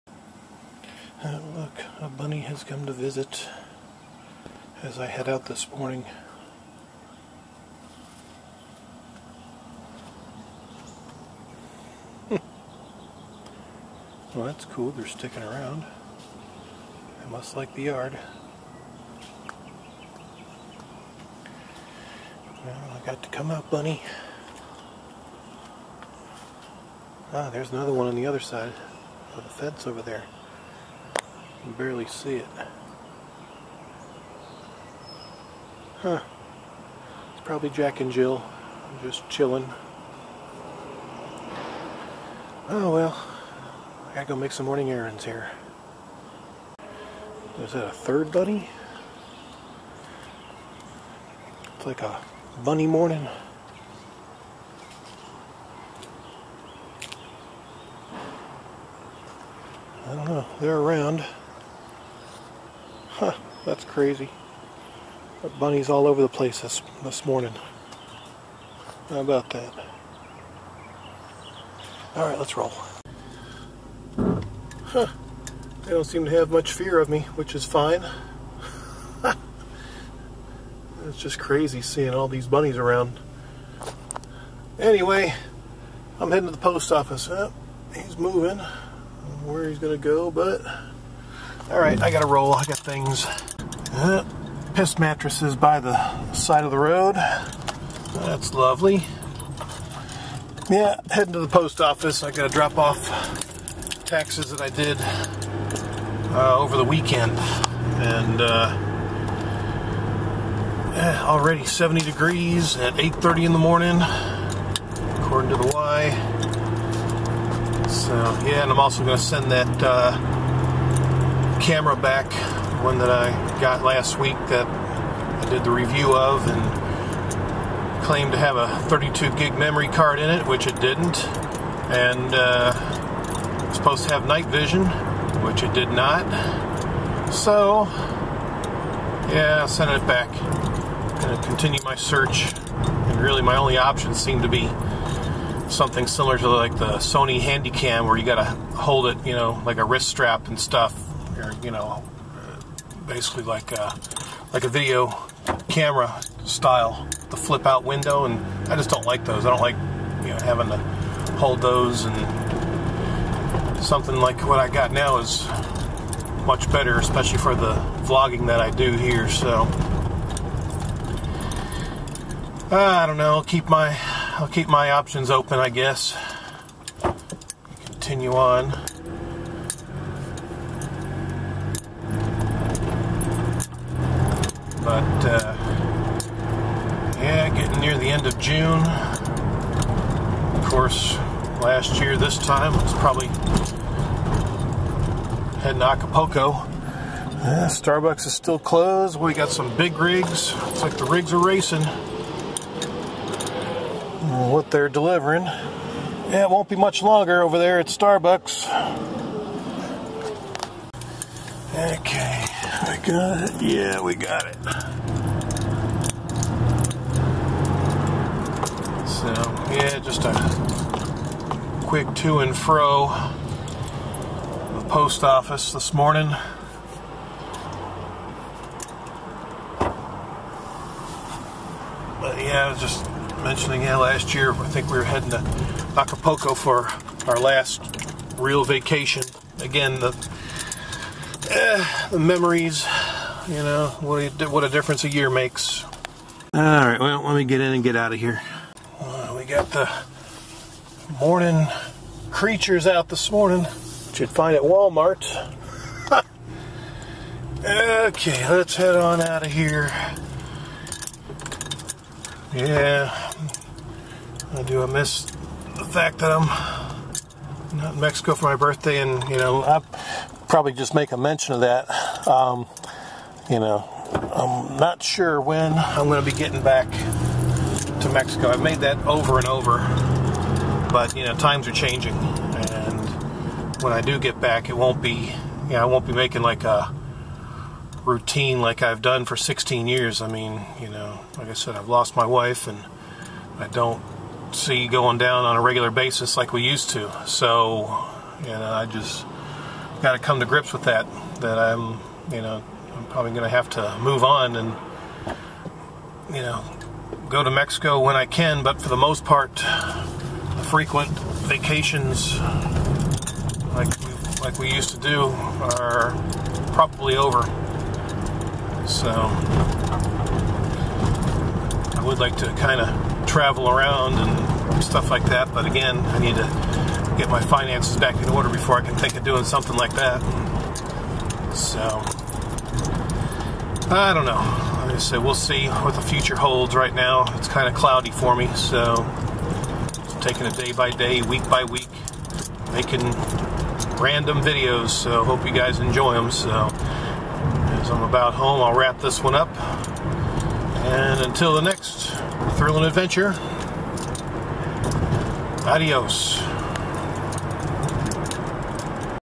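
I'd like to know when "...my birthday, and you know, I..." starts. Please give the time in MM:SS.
04:28.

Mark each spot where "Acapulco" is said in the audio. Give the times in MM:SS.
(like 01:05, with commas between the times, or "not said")
03:15, 03:55.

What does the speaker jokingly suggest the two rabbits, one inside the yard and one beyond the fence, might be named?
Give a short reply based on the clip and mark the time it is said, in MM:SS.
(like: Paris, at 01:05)
Jack and Jill, at 00:37.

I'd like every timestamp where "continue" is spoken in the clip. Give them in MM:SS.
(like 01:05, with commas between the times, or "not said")
02:21, 02:57.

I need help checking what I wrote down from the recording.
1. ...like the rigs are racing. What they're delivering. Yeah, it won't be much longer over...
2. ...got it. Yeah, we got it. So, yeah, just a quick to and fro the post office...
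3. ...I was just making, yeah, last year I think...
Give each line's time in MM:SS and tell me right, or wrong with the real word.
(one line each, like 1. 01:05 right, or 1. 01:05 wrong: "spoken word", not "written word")
1. 03:20 right
2. 03:33 right
3. 03:52 wrong: "mentioning", not "making".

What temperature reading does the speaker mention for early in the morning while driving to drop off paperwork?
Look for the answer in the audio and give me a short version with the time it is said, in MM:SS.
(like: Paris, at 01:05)
70 degrees, at 01:51.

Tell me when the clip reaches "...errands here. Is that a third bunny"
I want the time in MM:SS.
00:44.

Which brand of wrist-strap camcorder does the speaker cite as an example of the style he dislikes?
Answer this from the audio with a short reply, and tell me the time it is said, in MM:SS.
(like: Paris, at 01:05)
Sony Handycam, at 02:26.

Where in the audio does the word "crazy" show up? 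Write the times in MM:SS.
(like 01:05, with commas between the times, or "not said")
01:03, 01:21.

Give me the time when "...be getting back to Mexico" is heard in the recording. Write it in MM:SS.
04:36.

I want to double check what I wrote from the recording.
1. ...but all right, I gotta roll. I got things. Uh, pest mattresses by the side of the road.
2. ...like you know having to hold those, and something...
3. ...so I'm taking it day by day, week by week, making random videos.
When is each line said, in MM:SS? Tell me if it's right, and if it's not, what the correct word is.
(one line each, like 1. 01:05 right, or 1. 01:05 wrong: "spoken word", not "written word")
1. 01:30 right
2. 02:39 right
3. 05:38 right.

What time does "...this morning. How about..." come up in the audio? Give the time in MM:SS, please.
01:07.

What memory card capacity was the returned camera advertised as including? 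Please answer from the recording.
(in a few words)
32 gig.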